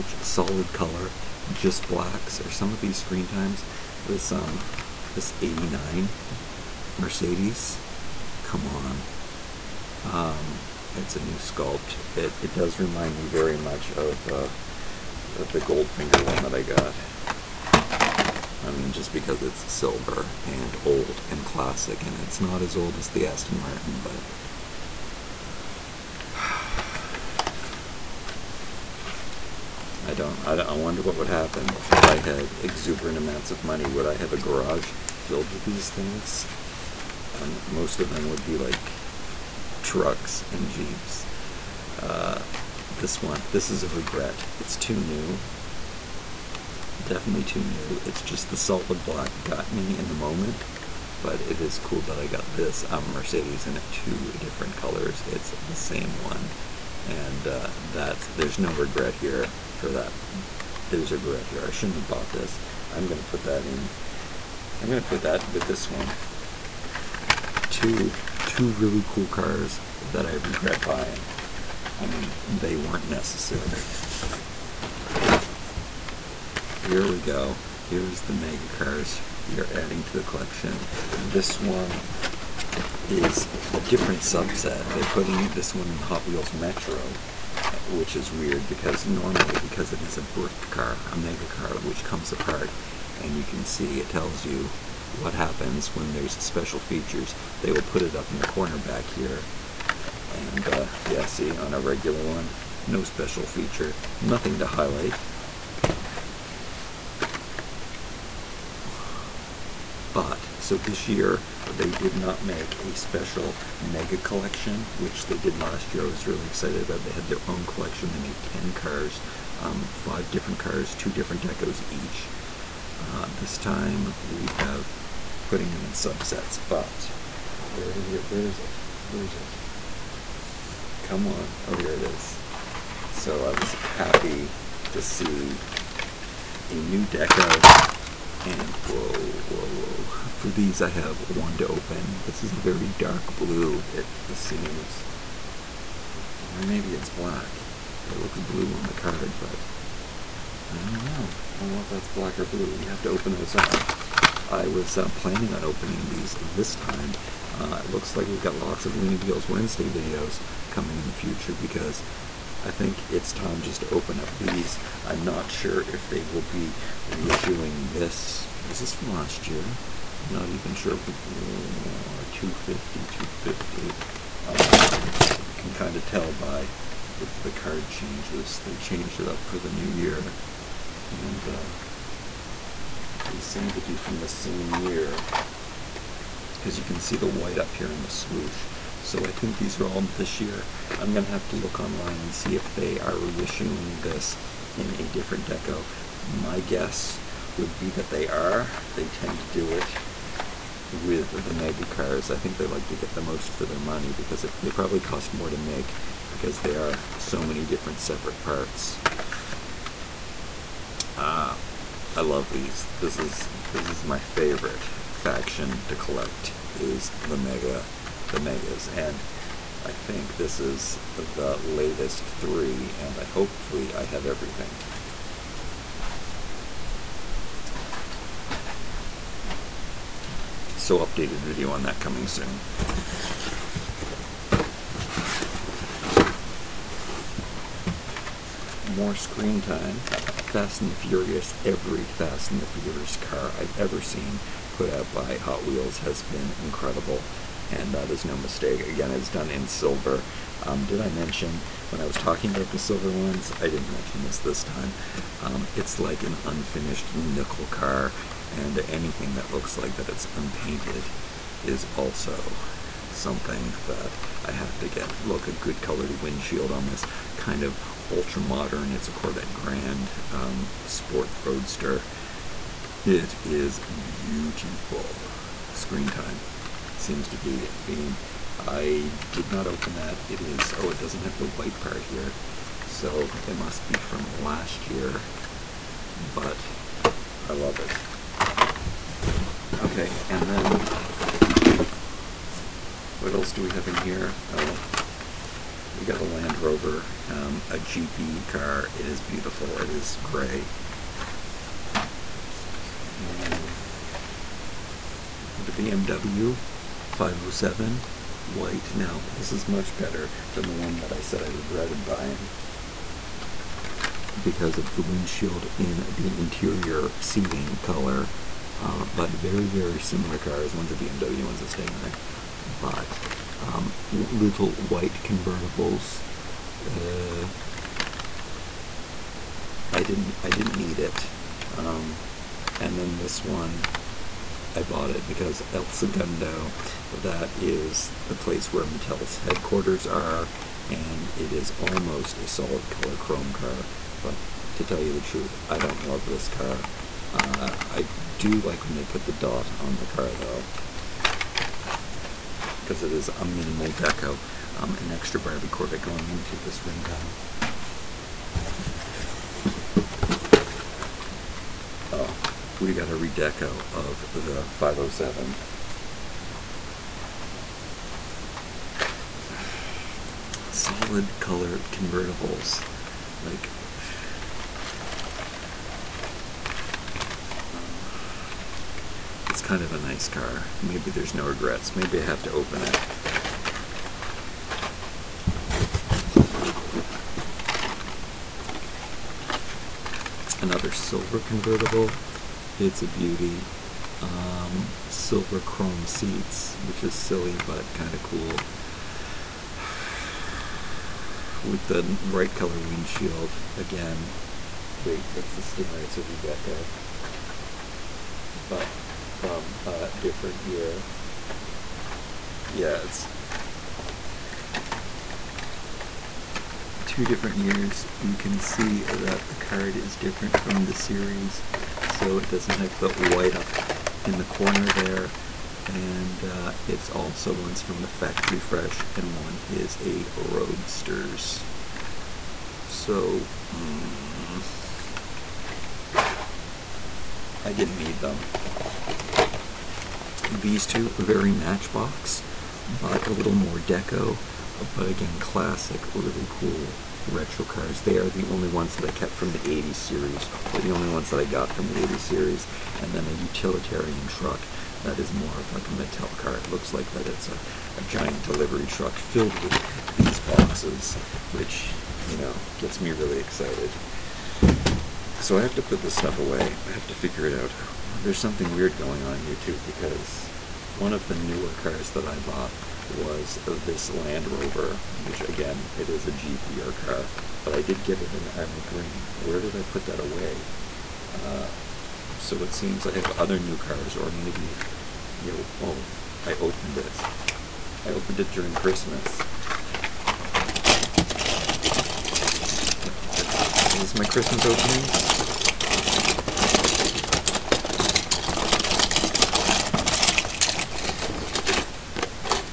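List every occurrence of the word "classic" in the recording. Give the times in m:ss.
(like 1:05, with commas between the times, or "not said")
0:21, 7:25.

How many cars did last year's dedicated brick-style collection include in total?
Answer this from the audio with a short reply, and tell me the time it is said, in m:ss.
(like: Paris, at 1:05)
10, at 1:58.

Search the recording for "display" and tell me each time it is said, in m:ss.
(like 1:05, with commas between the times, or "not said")
not said.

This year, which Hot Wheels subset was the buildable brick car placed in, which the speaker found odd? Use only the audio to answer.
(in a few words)
Hot Wheels Metro.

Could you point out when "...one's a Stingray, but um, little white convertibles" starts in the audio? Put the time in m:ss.
5:21.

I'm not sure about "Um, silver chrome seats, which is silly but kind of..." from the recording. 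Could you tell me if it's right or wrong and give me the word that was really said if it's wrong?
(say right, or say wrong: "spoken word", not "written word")
right.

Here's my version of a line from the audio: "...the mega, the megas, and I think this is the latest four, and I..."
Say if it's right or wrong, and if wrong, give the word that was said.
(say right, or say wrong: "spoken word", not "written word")
wrong: "three", not "four".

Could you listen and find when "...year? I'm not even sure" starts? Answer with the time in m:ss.
2:49.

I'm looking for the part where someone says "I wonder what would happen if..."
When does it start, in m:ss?
0:30.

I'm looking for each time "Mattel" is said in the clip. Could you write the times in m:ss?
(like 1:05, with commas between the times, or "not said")
5:38, 7:35.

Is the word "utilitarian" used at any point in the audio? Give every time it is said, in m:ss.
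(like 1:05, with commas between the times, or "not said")
7:33.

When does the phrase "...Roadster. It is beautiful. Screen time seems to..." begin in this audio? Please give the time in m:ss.
4:31.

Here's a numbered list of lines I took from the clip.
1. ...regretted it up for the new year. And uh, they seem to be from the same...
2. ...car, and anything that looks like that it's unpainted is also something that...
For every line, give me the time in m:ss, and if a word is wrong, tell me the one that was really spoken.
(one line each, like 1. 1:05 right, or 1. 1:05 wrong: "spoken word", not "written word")
1. 2:58 wrong: "changed", not "regretted"
2. 4:17 right.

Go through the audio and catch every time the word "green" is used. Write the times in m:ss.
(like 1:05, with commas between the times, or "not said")
7:58.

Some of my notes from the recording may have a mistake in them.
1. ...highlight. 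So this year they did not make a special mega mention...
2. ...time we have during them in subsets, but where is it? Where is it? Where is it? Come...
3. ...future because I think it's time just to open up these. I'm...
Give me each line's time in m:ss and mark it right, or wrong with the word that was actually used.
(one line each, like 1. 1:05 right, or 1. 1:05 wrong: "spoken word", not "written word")
1. 1:44 wrong: "collection", not "mention"
2. 2:03 wrong: "putting", not "during"
3. 2:41 right.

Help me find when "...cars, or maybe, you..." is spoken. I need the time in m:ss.
8:03.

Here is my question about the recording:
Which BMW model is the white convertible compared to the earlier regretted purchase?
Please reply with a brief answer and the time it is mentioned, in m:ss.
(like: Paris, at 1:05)
507, at 5:05.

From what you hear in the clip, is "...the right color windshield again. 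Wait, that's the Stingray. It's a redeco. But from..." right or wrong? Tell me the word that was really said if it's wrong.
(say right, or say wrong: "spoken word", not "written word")
right.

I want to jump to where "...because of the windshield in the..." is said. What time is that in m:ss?
5:14.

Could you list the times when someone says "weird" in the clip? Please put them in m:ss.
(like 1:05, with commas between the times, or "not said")
1:28, 7:48.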